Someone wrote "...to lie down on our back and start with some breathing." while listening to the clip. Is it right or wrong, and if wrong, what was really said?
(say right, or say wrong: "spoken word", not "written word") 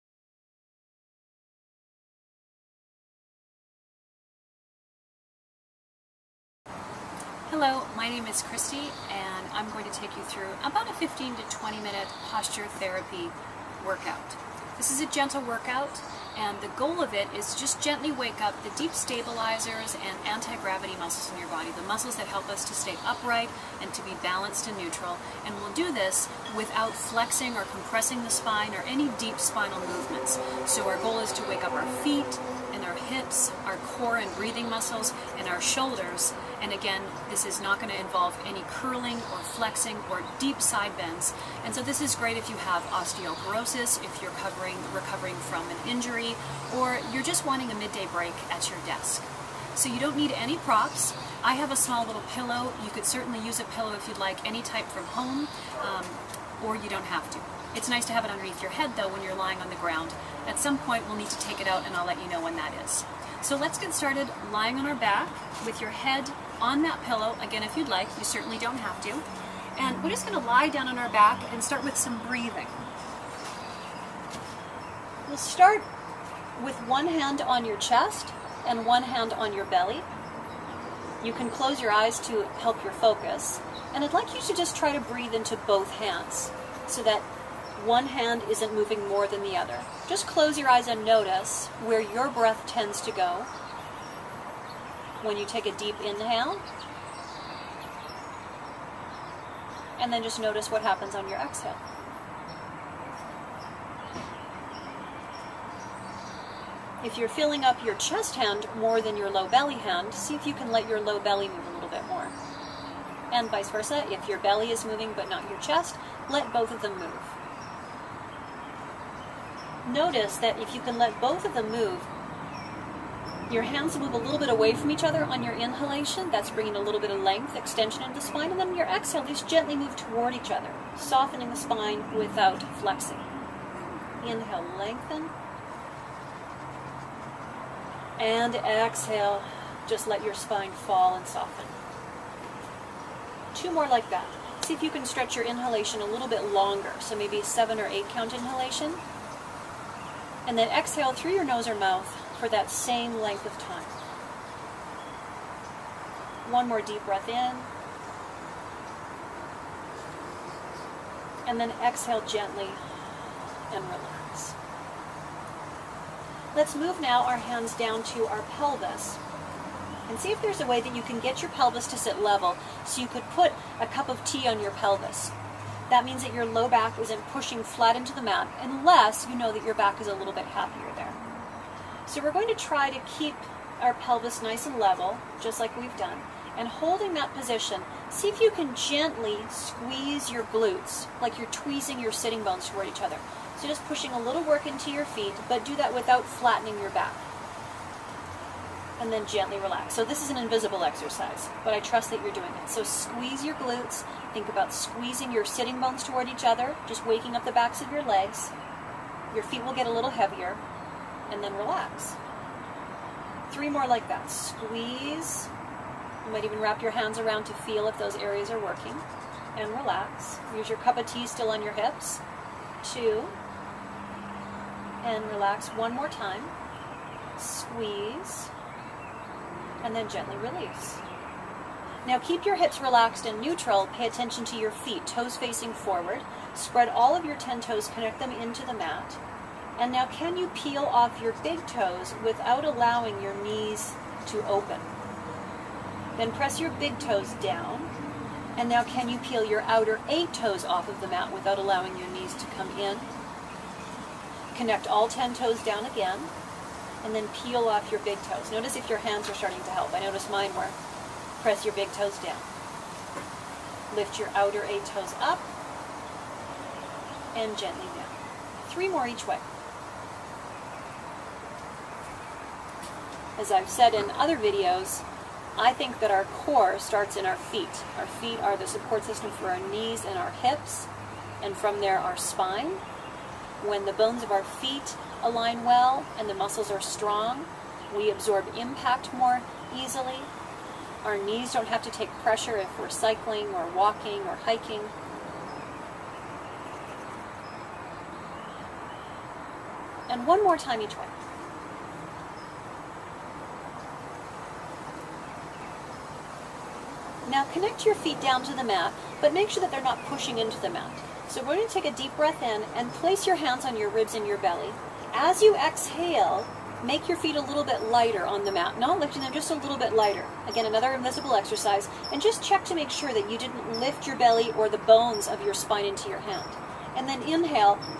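right.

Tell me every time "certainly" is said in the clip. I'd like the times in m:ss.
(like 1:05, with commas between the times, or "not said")
0:53, 1:08.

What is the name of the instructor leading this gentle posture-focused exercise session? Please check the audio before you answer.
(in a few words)
Kristi.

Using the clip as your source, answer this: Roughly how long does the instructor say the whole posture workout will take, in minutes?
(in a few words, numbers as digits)
15 to 20 minutes.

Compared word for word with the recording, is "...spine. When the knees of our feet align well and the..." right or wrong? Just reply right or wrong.
wrong.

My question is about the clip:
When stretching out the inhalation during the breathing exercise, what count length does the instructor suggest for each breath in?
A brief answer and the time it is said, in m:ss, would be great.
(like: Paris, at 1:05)
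7 or 8, at 2:27.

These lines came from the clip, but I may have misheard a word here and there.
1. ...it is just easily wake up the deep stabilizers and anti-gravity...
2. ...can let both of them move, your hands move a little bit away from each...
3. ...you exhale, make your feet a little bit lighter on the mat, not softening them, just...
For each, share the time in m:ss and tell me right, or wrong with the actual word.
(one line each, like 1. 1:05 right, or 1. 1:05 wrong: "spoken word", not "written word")
1. 0:17 wrong: "gently", not "easily"
2. 2:00 right
3. 5:15 wrong: "lifting", not "softening".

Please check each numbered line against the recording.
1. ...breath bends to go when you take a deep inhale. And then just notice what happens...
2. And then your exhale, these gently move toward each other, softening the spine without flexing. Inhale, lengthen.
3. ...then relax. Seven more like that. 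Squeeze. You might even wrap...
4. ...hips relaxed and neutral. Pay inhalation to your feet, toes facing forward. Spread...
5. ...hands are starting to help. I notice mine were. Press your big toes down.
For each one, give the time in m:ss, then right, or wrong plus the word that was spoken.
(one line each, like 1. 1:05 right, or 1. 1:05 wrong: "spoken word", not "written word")
1. 1:32 wrong: "tends", not "bends"
2. 2:08 right
3. 3:31 wrong: "Three", not "Seven"
4. 3:52 wrong: "attention", not "inhalation"
5. 4:18 right.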